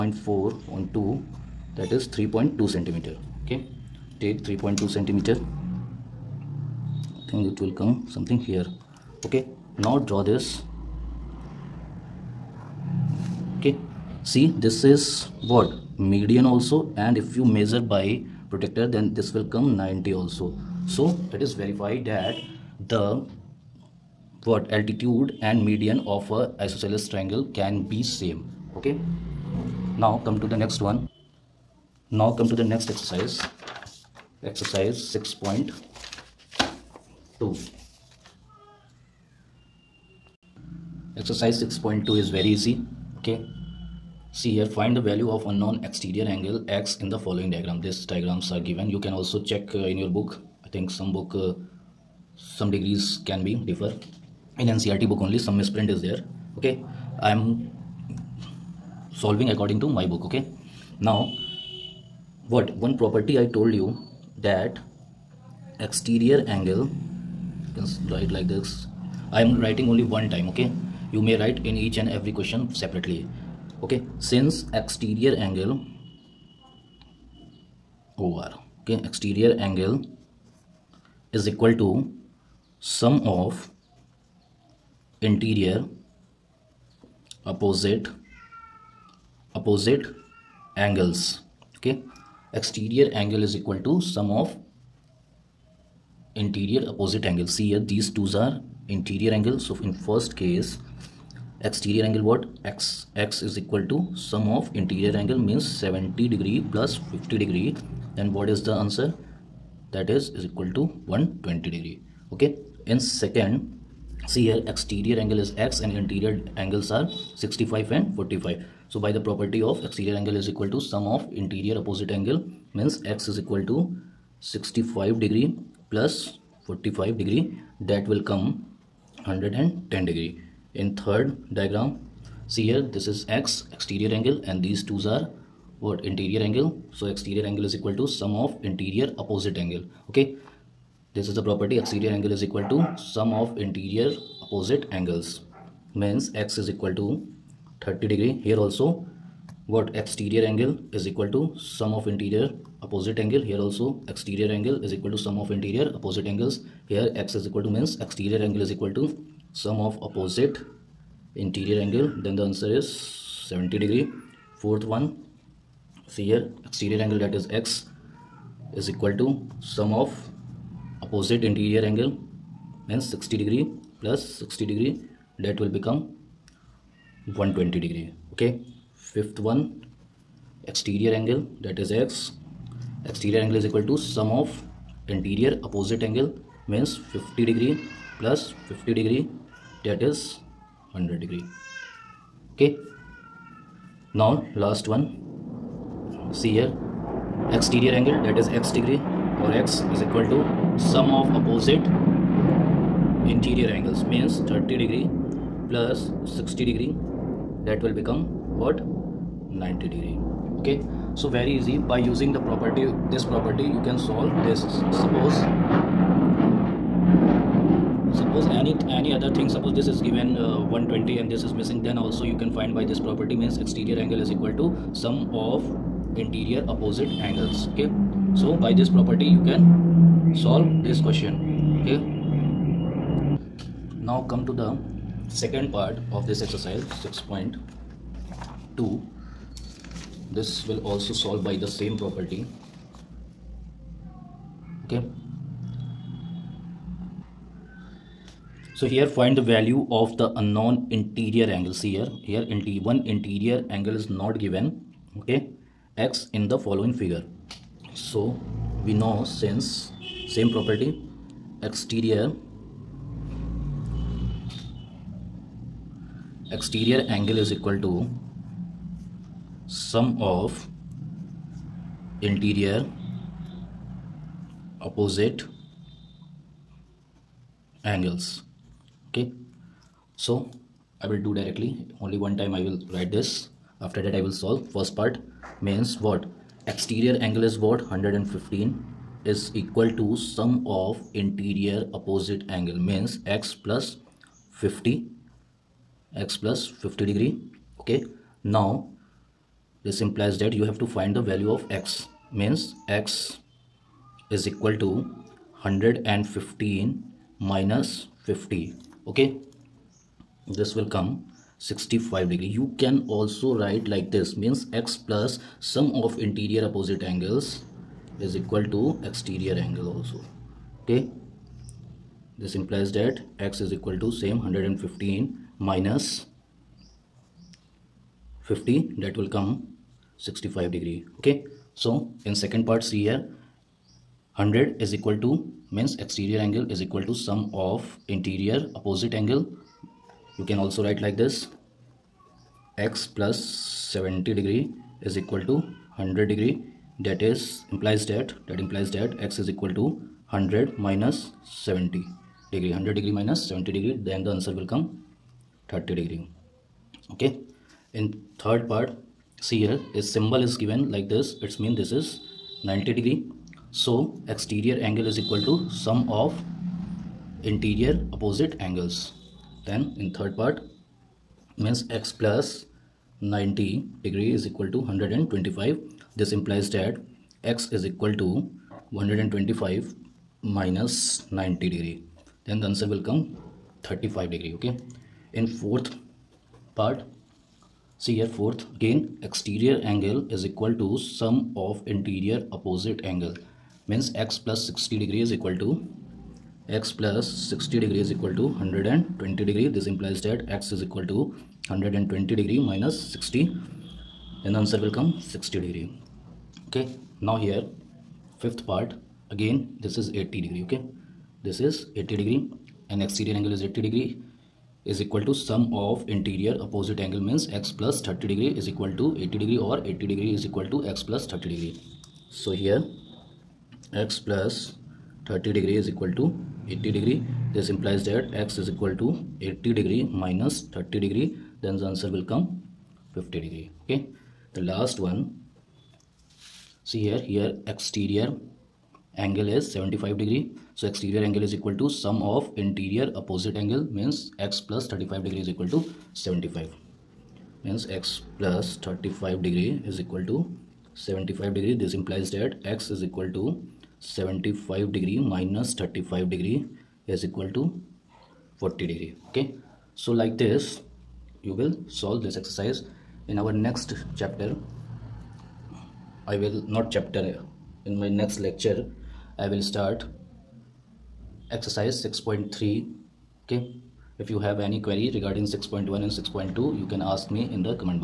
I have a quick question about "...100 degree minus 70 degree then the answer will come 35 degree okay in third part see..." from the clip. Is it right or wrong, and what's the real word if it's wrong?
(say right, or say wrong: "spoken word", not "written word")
wrong: "30", not "35".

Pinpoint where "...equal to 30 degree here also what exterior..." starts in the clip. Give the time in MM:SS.
02:26.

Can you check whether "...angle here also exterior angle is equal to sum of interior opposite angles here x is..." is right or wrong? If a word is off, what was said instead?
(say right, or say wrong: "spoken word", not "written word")
right.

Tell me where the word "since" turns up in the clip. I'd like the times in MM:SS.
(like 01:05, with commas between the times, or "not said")
01:14, 04:19.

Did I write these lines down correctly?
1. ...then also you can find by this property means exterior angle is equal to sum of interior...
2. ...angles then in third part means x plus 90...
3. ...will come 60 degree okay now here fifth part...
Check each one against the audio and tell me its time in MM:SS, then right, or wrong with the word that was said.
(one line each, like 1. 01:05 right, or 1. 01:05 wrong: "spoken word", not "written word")
1. 03:41 right
2. 06:08 right
3. 06:44 right.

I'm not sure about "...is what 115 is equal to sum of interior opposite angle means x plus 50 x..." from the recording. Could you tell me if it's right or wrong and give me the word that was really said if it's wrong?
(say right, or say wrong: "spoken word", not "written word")
right.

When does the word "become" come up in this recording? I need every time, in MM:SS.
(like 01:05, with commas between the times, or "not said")
02:55, 03:27.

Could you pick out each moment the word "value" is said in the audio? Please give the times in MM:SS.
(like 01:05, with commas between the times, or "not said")
00:45, 04:09, 05:01.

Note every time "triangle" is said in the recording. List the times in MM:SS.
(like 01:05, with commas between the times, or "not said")
00:27.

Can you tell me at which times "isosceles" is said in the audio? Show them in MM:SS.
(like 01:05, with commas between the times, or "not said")
00:26.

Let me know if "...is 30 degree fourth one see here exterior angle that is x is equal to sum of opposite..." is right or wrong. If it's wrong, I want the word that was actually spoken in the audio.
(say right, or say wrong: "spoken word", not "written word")
wrong: "70", not "30".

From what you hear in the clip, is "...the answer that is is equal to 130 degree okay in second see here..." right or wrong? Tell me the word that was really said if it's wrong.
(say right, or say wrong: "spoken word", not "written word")
wrong: "120", not "130".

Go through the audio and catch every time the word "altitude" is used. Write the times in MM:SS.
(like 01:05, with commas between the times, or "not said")
00:24.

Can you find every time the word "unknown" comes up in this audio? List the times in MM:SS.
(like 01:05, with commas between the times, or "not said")
00:45, 04:10.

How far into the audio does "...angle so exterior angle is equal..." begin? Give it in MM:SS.
02:16.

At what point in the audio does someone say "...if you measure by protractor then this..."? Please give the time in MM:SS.
00:17.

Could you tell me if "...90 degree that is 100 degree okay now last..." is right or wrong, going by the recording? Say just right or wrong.
wrong.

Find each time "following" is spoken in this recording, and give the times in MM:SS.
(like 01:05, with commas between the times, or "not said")
00:47, 04:16.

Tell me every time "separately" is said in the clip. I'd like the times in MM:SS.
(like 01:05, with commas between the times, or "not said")
01:12.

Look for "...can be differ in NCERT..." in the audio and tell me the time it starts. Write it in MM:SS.
00:53.